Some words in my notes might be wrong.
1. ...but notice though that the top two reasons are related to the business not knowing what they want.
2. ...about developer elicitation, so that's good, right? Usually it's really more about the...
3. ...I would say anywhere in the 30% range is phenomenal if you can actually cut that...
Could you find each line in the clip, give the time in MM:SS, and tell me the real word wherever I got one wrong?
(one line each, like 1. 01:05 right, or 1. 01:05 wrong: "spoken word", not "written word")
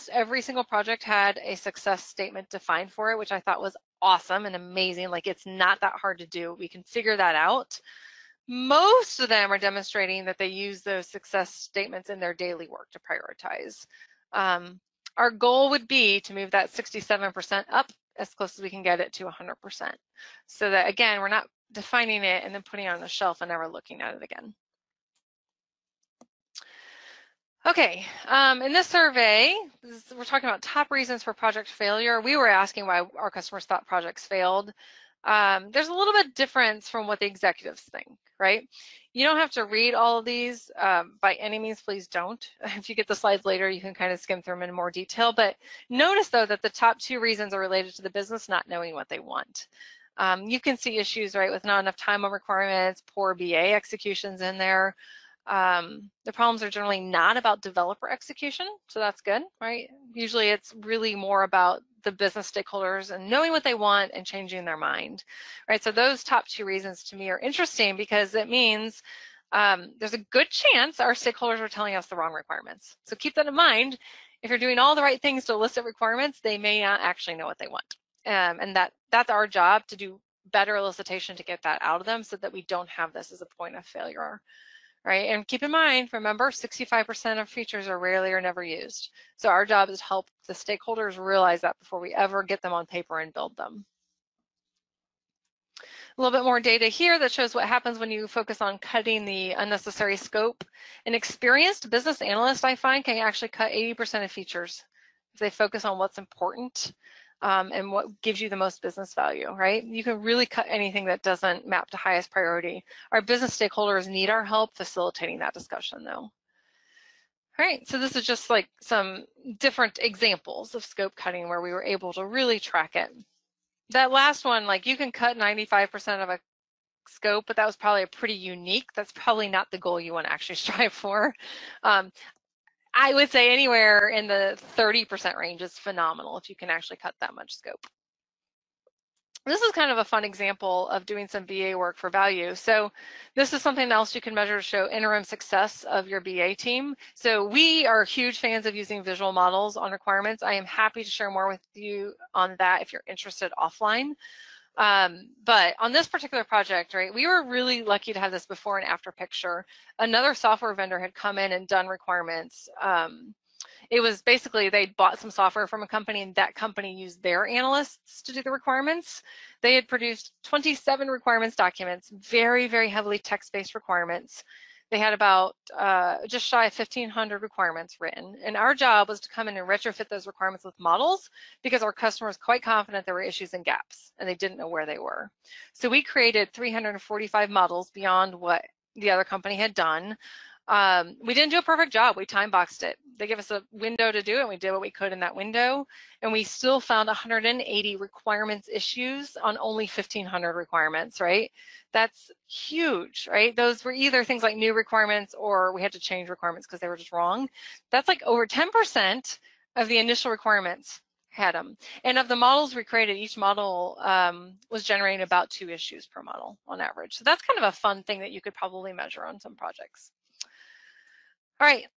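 1. 00:45 right
2. 00:57 wrong: "execution", not "elicitation"
3. 02:12 right.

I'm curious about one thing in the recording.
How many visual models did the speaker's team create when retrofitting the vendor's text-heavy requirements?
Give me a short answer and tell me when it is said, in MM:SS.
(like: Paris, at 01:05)
345, at 03:06.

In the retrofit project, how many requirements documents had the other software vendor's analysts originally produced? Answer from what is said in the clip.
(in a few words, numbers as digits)
27.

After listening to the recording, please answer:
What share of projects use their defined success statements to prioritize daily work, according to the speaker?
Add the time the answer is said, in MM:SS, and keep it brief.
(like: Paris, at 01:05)
67%, at 00:16.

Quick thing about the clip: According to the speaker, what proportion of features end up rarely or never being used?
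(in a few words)
65%.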